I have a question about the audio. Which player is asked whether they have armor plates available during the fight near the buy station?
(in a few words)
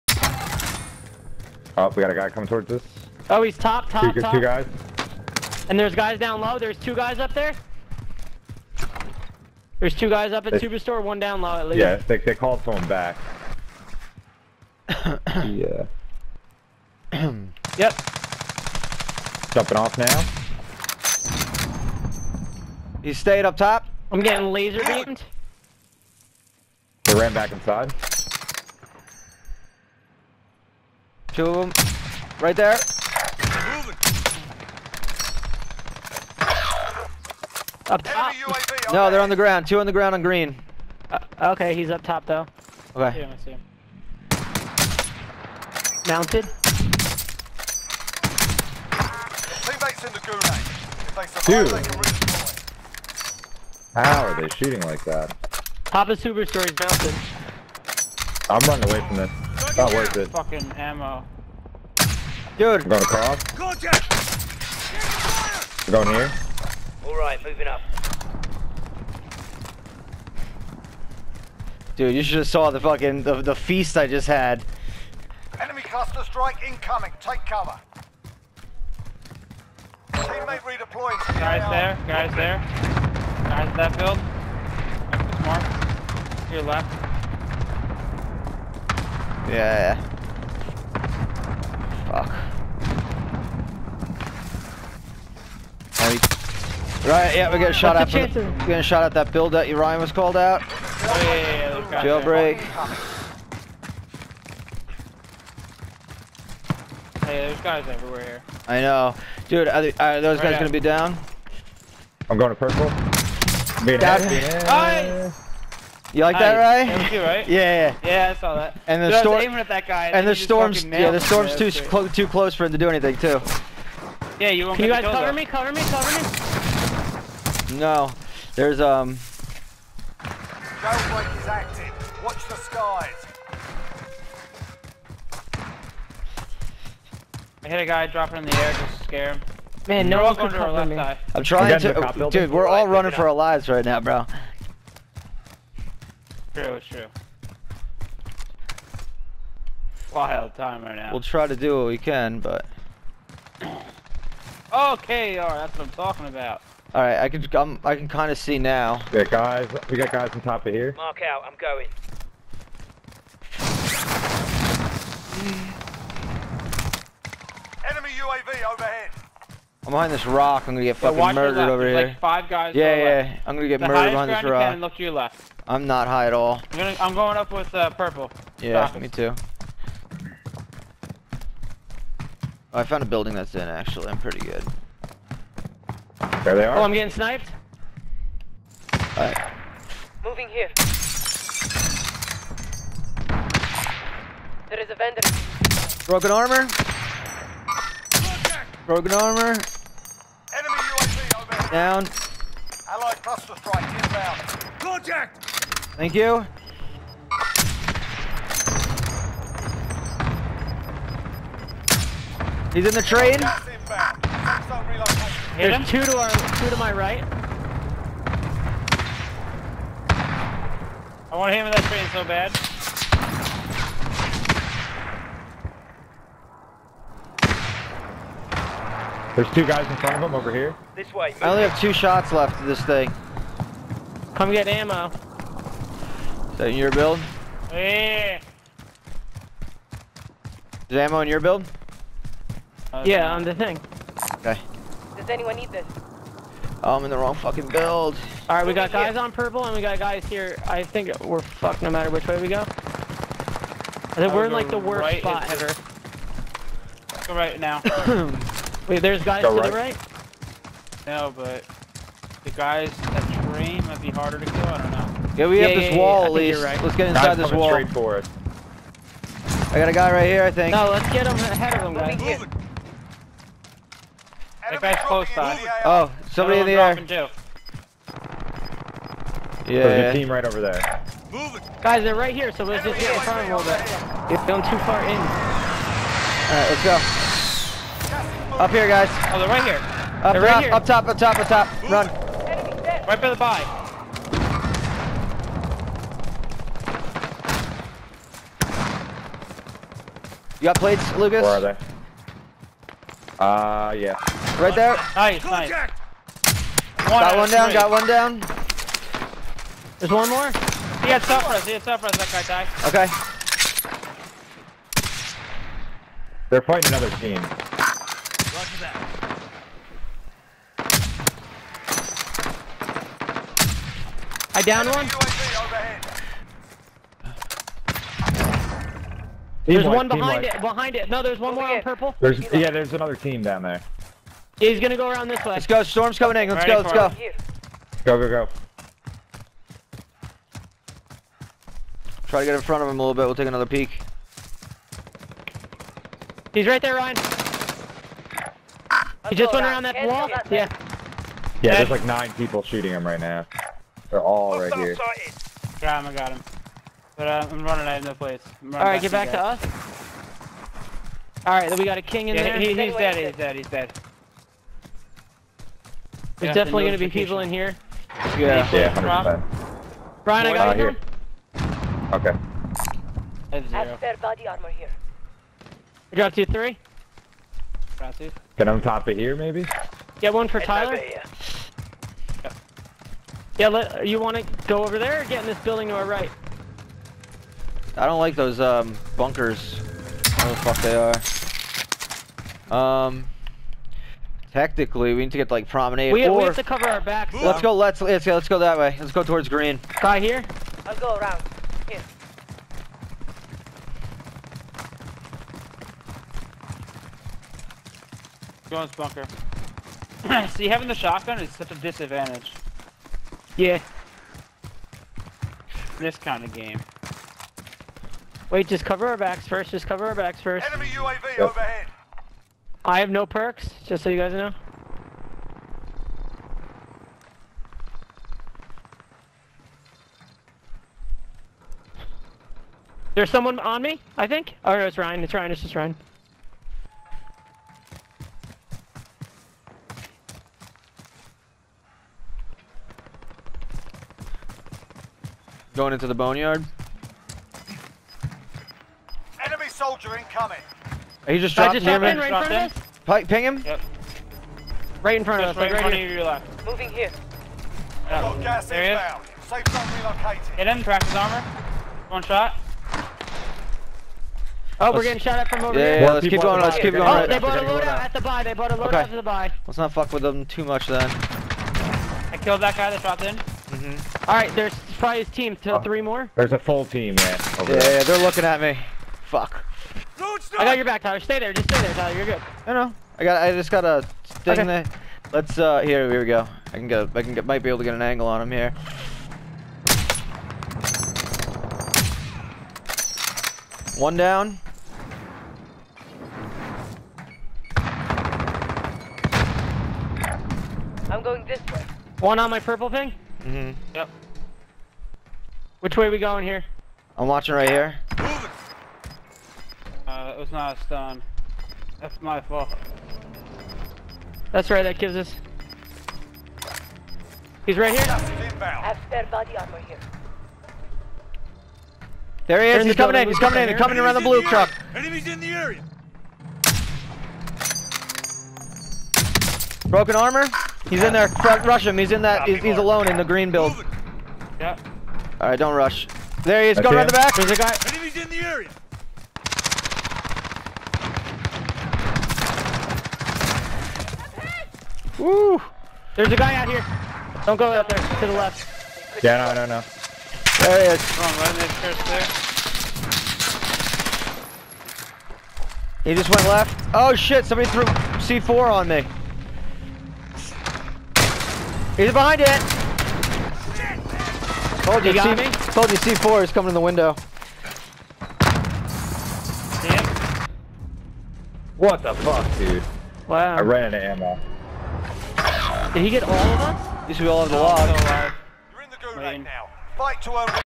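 Lucas.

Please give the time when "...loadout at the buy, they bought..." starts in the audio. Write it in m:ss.
7:47.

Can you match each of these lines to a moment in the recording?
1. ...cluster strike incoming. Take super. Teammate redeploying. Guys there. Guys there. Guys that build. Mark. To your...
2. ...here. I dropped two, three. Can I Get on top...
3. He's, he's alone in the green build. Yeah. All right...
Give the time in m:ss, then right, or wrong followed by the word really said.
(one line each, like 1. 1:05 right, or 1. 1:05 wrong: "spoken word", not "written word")
1. 1:15 wrong: "cover", not "super"
2. 6:14 right
3. 8:52 right.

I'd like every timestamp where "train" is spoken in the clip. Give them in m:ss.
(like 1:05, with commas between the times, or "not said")
3:33, 3:41, 4:23.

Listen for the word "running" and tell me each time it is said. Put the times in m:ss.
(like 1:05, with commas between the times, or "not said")
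0:58, 2:22, 5:57.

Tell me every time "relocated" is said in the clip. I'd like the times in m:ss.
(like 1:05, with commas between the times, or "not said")
7:39.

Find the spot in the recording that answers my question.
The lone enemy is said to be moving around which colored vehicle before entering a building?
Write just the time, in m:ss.
8:44.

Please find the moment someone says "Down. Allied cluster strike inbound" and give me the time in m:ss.
3:21.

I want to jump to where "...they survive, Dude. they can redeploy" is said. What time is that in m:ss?
0:51.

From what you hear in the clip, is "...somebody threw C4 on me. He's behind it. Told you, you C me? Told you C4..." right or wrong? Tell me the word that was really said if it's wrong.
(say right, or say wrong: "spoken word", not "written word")
right.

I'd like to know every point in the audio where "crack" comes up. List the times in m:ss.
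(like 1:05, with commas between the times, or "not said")
7:40.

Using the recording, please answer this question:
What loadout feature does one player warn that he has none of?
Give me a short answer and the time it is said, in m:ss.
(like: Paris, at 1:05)
perks, at 7:02.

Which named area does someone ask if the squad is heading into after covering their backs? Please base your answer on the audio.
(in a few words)
the boneyard.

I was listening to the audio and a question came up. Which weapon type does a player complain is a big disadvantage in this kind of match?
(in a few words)
shotgun.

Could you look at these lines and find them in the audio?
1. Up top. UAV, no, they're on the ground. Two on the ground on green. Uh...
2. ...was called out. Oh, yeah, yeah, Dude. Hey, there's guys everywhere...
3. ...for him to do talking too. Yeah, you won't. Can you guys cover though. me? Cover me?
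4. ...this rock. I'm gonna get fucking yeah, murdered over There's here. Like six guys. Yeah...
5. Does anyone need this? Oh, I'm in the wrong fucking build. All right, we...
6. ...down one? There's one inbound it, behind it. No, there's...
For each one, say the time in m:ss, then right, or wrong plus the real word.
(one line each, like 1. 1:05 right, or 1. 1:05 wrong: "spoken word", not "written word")
1. 0:37 right
2. 1:40 wrong: "Jailbreak", not "Dude"
3. 2:02 wrong: "anything", not "talking"
4. 2:50 wrong: "five", not "six"
5. 4:05 right
6. 5:24 wrong: "behind", not "inbound".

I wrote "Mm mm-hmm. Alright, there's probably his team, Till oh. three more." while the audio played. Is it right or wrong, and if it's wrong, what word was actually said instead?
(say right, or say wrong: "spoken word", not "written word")
right.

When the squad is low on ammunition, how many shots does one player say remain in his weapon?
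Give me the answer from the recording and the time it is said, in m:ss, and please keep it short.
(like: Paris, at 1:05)
2, at 3:51.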